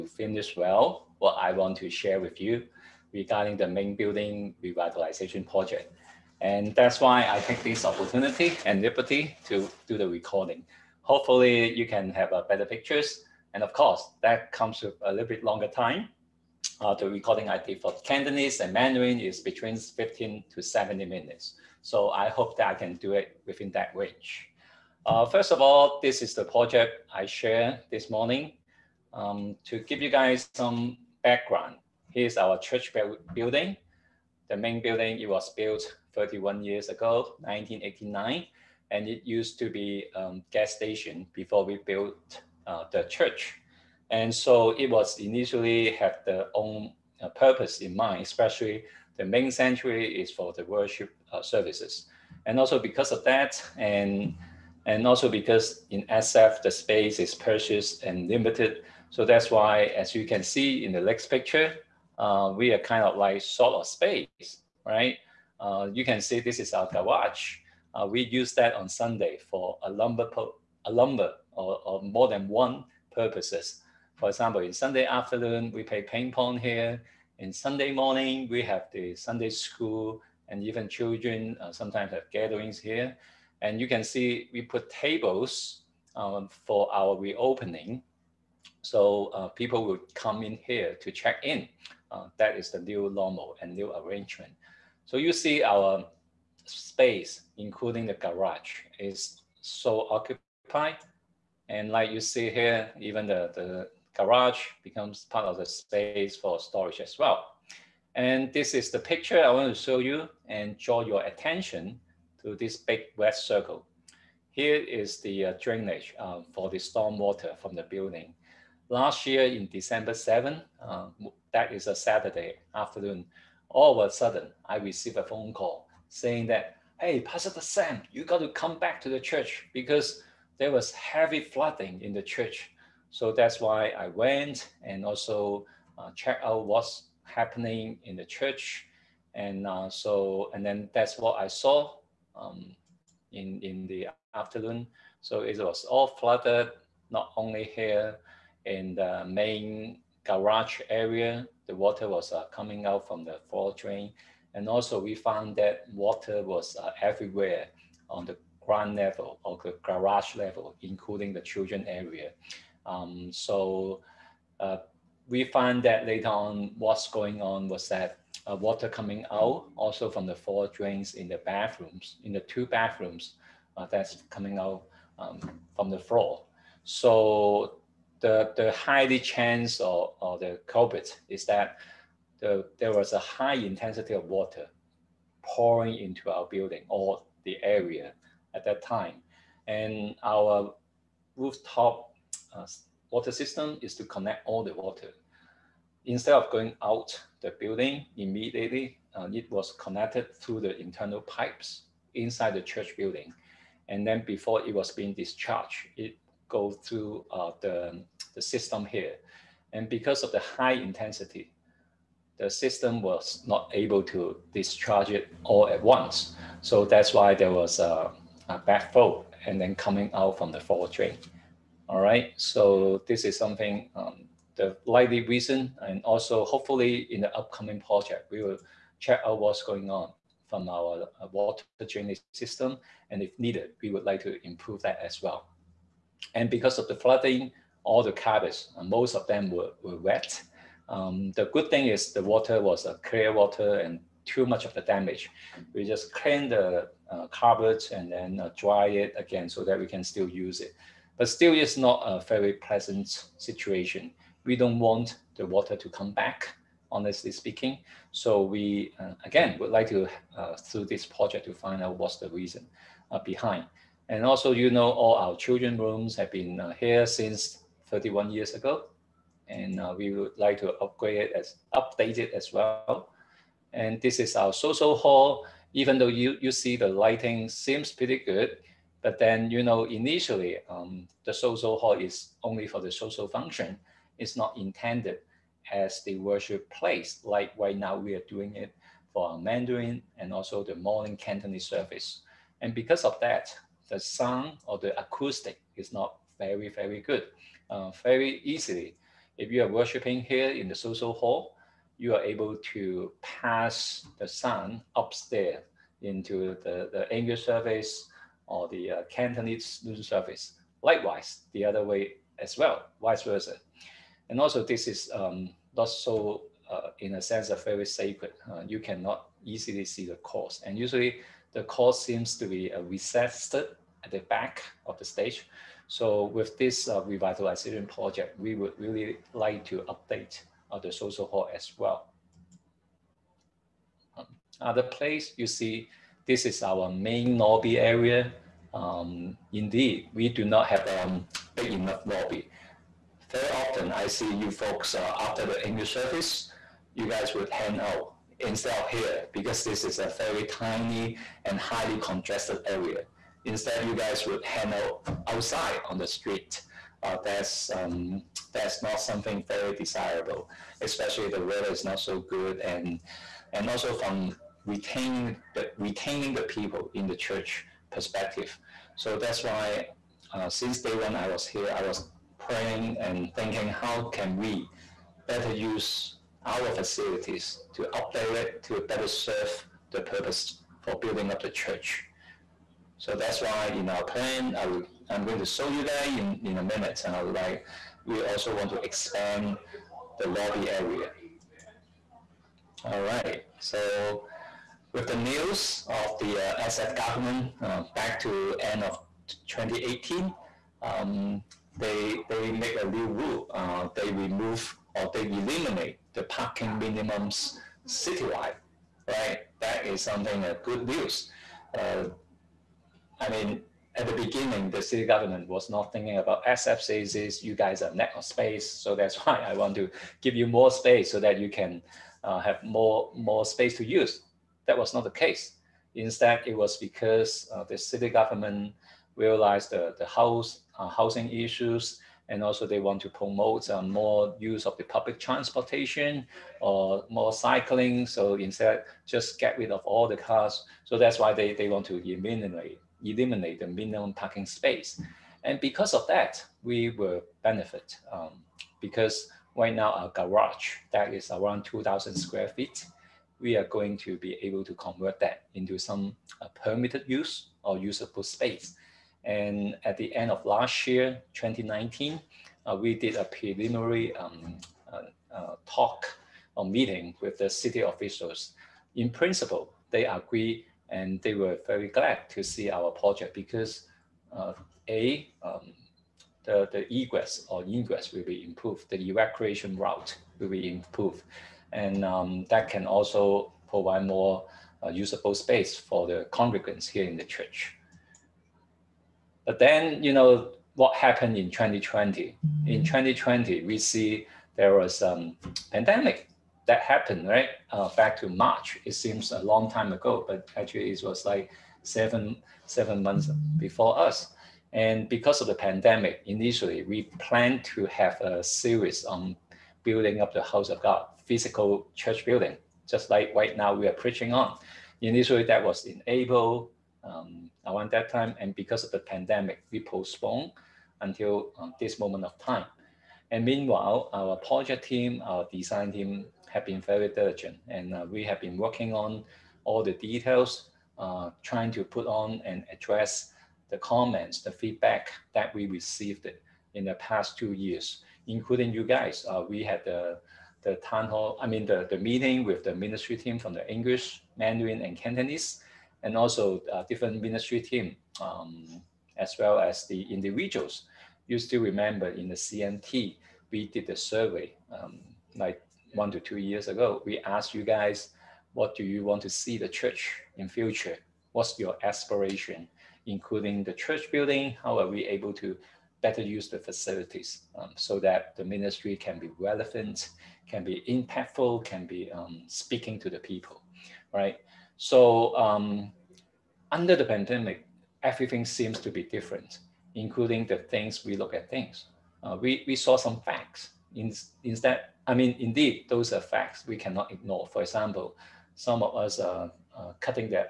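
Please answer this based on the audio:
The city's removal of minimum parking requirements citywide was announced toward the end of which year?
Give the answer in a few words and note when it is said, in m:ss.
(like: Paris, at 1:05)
2018, at 6:39.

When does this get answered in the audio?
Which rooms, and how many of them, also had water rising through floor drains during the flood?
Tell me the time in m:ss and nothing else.
2:52.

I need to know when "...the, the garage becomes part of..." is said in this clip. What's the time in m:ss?
1:43.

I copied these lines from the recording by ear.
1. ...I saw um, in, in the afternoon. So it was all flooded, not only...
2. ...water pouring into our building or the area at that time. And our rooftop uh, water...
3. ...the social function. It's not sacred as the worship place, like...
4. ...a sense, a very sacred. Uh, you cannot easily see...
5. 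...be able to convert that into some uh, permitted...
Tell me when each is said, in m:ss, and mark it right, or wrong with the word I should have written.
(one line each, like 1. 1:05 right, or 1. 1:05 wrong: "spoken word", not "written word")
1. 2:21 right
2. 3:04 right
3. 4:42 wrong: "intended", not "sacred"
4. 5:17 right
5. 7:34 right.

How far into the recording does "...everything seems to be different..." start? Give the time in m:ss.
9:38.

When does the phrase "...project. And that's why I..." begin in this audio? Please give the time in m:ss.
0:05.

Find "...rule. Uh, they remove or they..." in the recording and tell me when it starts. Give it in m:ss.
6:43.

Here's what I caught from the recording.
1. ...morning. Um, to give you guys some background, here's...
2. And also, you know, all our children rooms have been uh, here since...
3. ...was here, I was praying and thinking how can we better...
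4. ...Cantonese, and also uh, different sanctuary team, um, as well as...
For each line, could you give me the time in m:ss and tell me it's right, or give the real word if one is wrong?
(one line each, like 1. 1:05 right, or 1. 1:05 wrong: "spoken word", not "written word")
1. 0:28 right
2. 4:24 right
3. 6:11 right
4. 9:04 wrong: "ministry", not "sanctuary".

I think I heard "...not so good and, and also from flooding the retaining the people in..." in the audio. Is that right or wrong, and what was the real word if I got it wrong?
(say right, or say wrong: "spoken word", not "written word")
wrong: "retaining", not "flooding".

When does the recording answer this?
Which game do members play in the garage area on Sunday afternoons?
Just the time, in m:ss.
1:16.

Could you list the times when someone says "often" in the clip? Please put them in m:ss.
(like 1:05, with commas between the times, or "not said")
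5:43.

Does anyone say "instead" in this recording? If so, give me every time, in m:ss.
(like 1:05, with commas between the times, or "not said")
3:16, 5:48, 5:53, 7:05, 7:18, 9:44.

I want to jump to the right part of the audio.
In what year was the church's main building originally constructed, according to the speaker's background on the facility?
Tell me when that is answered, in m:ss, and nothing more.
0:37.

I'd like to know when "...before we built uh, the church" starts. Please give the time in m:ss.
0:41.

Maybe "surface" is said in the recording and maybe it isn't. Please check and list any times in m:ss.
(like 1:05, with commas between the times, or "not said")
5:10.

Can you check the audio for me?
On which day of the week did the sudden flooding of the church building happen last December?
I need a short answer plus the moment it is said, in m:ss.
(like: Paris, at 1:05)
Saturday, at 2:01.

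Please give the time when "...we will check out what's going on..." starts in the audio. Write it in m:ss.
3:48.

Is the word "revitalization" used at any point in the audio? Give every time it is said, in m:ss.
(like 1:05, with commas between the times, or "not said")
0:04, 5:27.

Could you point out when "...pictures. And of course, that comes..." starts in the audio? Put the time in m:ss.
0:12.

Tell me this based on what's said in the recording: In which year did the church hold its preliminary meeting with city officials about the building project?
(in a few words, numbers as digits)
2019.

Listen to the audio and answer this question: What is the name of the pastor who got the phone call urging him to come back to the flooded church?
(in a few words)
Pastor Sam.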